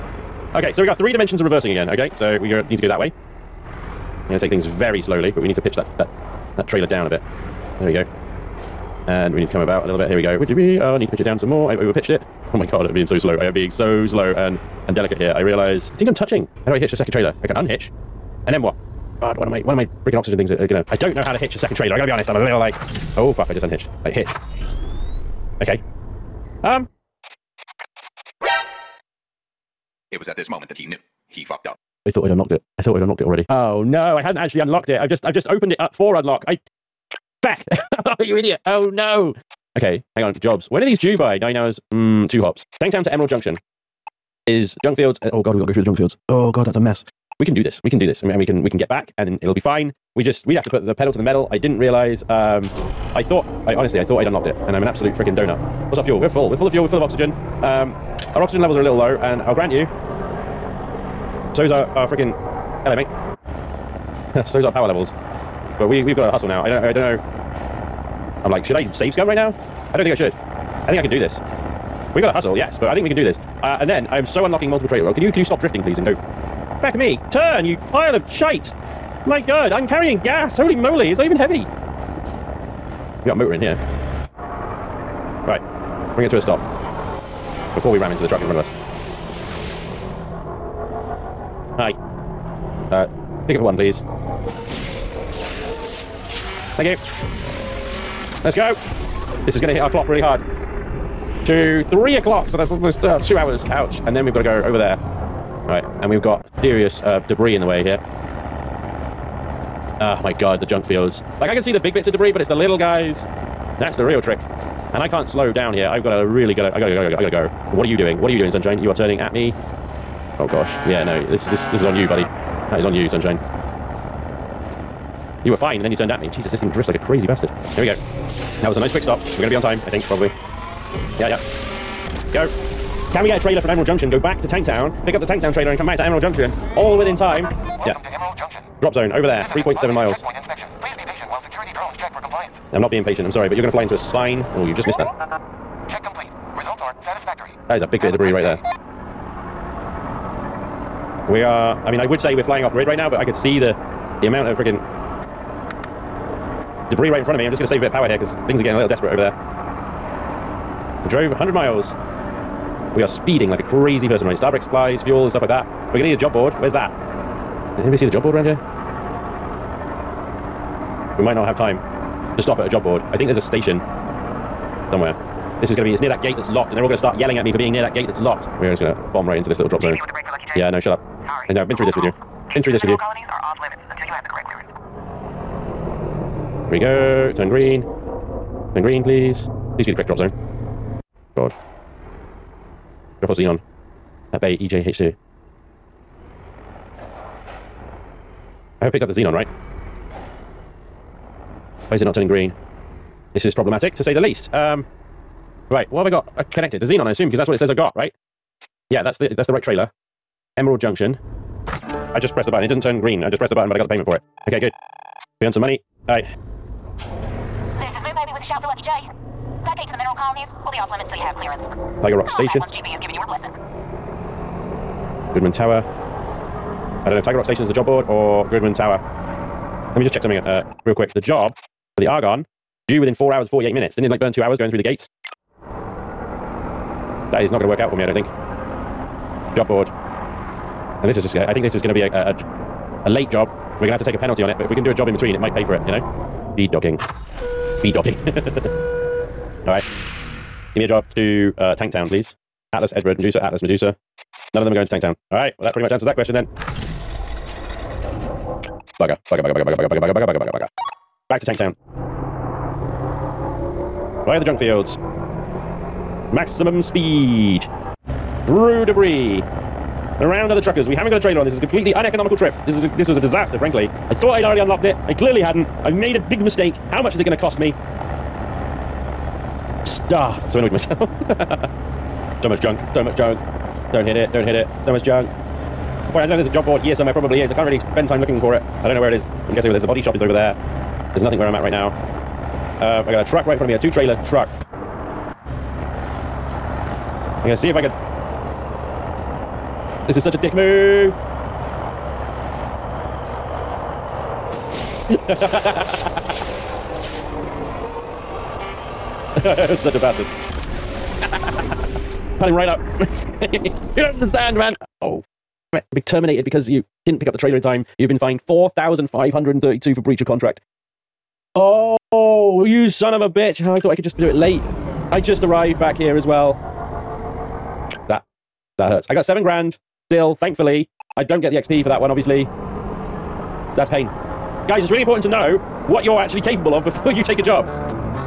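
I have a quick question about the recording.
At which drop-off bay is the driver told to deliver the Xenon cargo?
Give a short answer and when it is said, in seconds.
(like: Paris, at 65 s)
EJH2, at 194 s.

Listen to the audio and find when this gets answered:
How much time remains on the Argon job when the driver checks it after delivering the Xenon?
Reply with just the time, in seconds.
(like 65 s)
233 s.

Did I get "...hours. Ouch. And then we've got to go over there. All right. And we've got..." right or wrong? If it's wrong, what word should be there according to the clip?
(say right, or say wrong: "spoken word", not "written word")
right.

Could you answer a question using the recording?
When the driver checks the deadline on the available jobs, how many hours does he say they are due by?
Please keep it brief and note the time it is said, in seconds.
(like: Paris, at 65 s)
9 hours, at 41 s.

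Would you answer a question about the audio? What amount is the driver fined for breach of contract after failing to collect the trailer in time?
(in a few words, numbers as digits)
4,532.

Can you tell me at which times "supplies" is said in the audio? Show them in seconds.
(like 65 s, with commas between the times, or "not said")
164 s.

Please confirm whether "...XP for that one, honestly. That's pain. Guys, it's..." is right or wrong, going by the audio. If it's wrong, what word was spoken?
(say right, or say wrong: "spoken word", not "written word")
wrong: "obviously", not "honestly".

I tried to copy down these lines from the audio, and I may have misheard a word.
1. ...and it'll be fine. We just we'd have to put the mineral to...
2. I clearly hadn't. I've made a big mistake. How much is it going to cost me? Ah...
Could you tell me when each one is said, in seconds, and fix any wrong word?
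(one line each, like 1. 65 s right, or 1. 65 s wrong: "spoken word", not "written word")
1. 49 s wrong: "pedal", not "mineral"
2. 275 s right.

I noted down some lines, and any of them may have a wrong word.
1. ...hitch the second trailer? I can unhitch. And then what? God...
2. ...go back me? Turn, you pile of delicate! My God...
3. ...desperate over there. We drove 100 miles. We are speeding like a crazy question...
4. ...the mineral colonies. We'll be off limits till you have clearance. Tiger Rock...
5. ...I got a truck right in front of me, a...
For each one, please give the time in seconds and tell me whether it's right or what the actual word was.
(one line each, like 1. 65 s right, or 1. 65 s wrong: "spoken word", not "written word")
1. 16 s right
2. 76 s wrong: "shite", not "delicate"
3. 158 s wrong: "person", not "question"
4. 219 s right
5. 293 s right.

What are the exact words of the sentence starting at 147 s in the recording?
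That is a big Have bit of debris right day.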